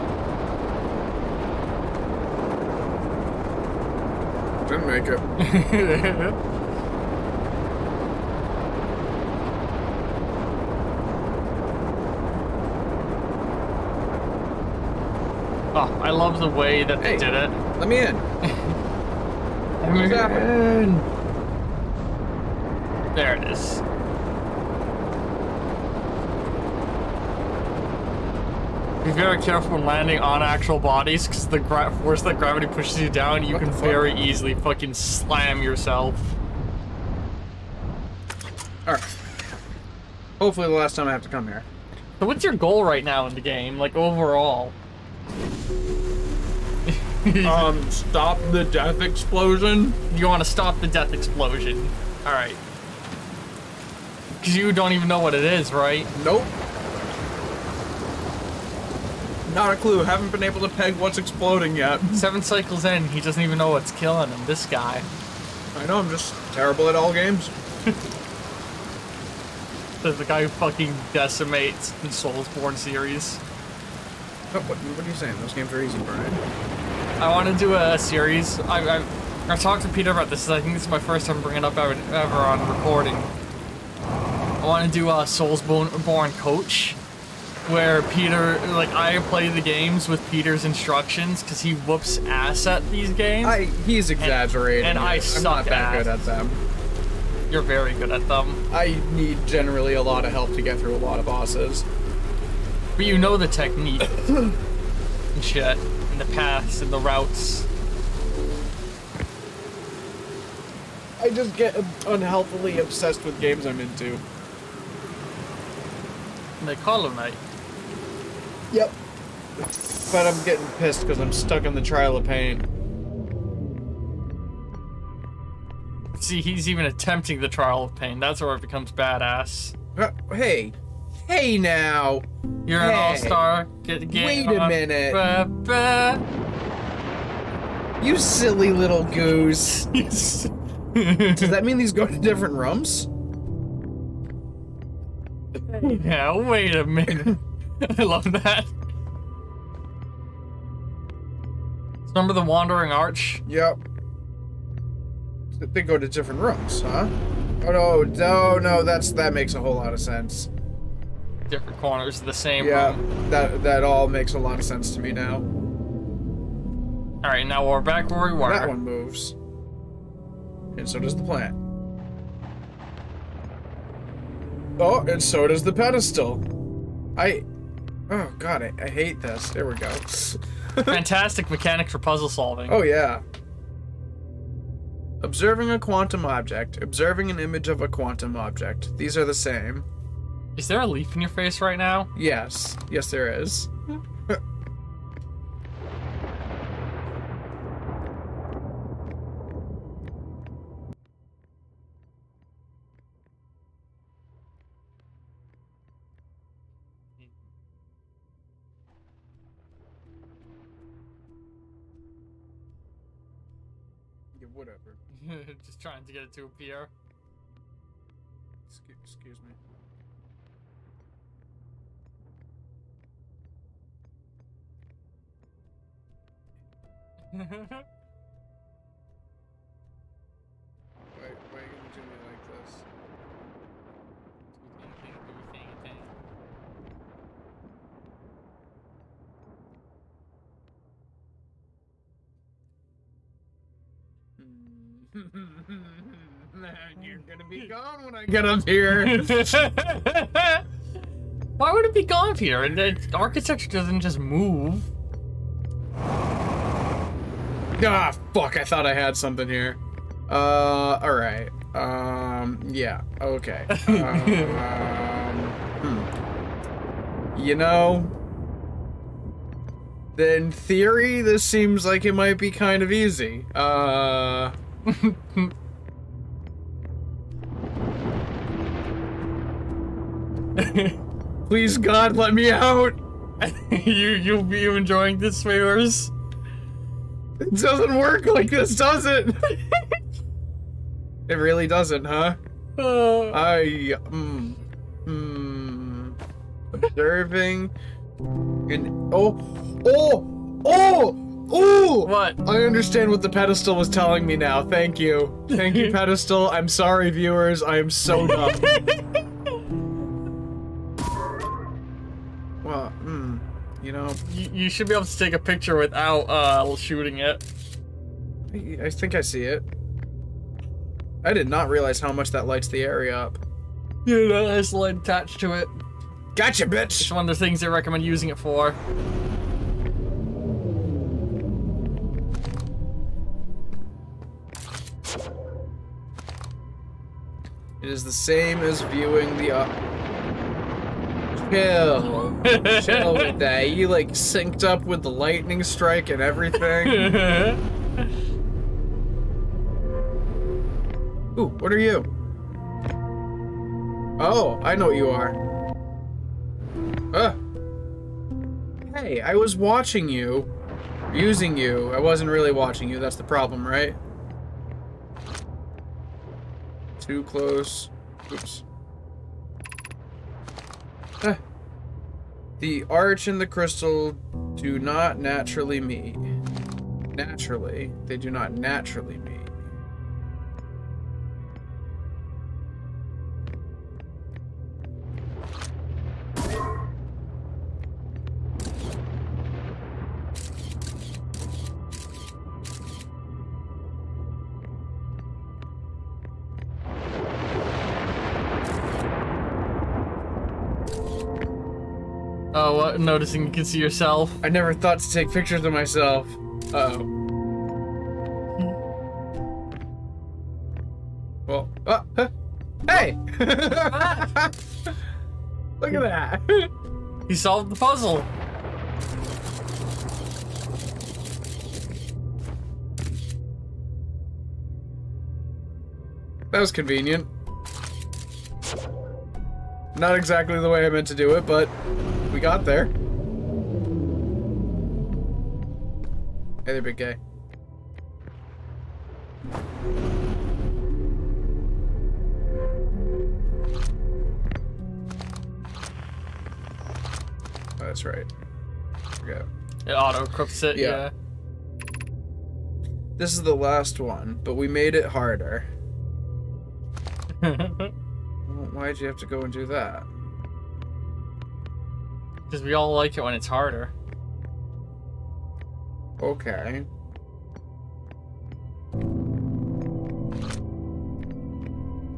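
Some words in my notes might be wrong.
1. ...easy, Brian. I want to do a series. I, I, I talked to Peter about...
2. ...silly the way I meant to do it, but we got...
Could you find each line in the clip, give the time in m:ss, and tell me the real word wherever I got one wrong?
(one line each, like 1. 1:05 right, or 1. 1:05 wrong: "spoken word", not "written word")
1. 1:15 right
2. 7:10 wrong: "exactly", not "silly".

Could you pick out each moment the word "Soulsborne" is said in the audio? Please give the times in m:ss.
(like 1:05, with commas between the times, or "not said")
1:12, 1:25.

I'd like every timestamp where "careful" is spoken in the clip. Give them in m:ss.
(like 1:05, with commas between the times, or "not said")
0:29.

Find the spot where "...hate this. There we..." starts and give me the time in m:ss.
2:58.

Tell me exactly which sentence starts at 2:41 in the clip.
Different corners of the same yeah, room.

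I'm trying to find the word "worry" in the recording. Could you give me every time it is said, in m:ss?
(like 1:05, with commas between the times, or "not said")
not said.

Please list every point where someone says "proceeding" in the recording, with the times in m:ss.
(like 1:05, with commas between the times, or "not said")
not said.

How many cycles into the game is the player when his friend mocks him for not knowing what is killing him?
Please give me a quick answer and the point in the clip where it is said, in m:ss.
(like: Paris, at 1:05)
7, at 1:02.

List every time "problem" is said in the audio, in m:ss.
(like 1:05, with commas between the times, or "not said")
6:03.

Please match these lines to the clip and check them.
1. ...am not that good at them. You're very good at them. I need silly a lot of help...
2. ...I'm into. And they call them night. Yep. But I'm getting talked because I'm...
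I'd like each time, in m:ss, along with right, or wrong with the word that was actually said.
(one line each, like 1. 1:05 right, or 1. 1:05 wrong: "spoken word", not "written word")
1. 1:35 wrong: "generally", not "silly"
2. 1:53 wrong: "pissed", not "talked".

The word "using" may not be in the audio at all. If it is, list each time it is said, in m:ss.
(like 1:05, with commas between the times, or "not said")
5:28, 6:01.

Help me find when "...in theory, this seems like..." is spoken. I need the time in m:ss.
4:30.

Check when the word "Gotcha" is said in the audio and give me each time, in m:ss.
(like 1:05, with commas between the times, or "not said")
5:26.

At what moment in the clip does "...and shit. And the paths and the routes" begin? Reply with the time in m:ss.
1:44.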